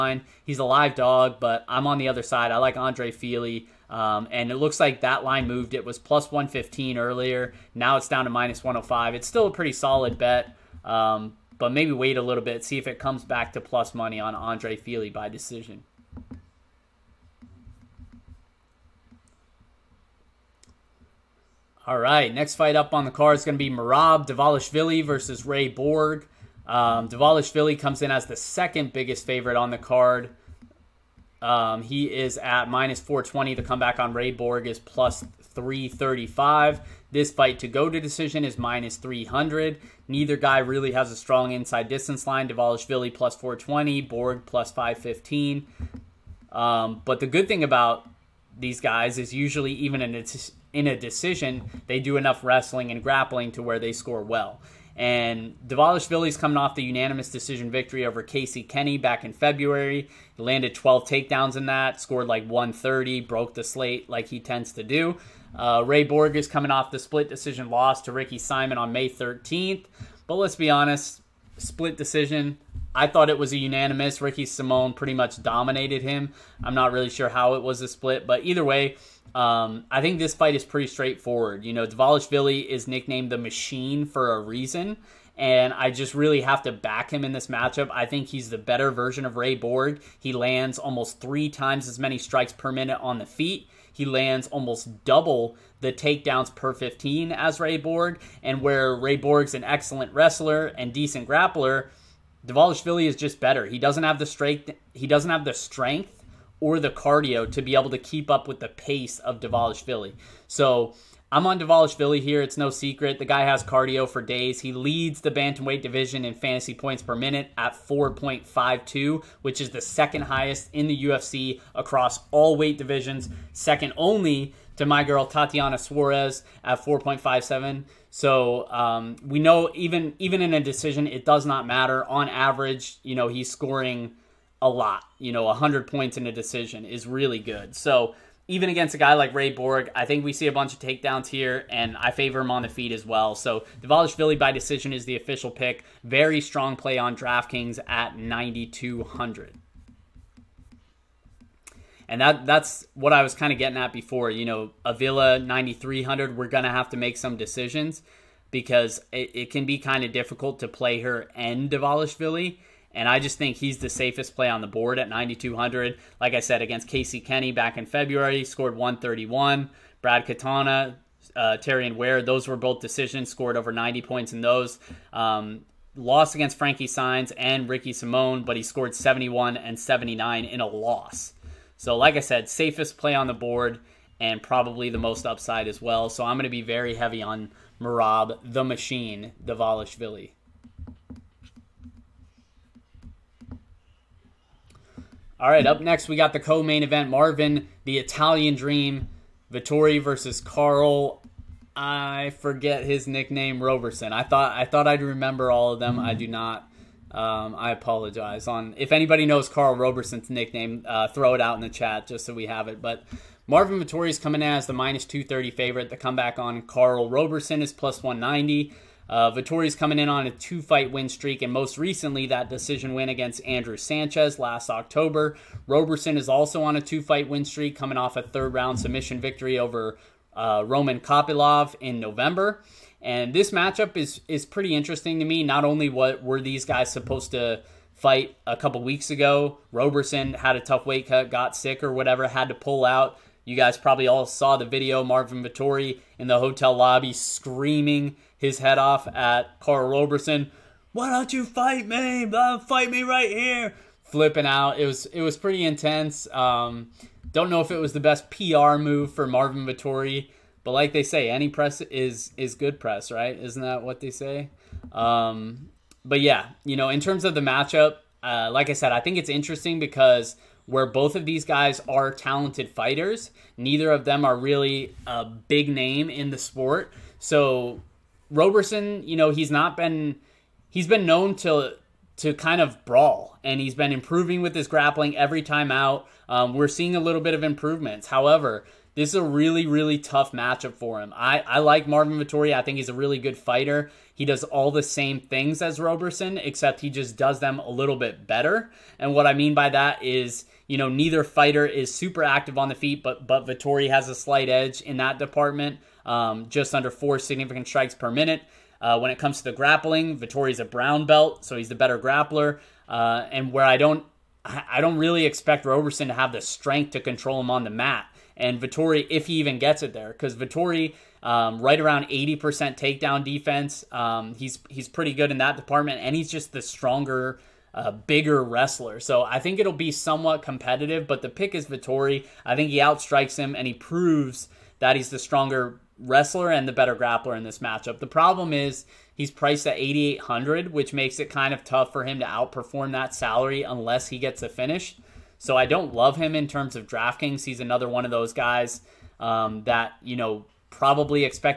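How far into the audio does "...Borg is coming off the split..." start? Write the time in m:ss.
1:06.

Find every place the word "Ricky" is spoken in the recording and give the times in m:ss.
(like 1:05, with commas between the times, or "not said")
1:08, 1:14, 2:57.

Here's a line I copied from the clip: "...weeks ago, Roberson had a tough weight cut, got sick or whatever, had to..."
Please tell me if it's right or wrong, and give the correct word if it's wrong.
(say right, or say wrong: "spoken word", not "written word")
right.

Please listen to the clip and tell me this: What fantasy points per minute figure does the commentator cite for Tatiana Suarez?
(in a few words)
4.57.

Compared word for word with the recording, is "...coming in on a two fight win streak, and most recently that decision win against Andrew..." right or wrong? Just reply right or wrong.
right.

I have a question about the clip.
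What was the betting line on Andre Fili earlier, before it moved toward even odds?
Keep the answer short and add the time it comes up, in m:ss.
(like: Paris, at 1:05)
+115, at 0:05.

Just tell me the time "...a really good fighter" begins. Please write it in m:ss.
4:52.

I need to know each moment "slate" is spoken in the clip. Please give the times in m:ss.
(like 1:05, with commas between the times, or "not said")
1:03.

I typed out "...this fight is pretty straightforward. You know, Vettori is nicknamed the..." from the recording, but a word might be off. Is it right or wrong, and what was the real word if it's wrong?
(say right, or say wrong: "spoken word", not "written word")
wrong: "Dvalishvili", not "Vettori".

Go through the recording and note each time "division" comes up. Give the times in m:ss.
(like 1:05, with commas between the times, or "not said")
1:55, 2:02.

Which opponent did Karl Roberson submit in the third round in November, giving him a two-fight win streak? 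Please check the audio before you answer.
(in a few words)
Roman Kopylov.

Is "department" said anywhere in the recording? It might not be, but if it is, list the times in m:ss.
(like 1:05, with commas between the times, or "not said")
5:05, 5:25.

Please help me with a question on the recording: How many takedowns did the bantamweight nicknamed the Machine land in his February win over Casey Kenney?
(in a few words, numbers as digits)
12.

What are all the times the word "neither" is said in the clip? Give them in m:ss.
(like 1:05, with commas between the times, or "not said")
0:40, 4:33, 5:00.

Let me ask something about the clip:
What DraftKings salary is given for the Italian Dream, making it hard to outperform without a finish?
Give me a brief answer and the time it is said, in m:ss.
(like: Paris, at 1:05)
8800, at 5:39.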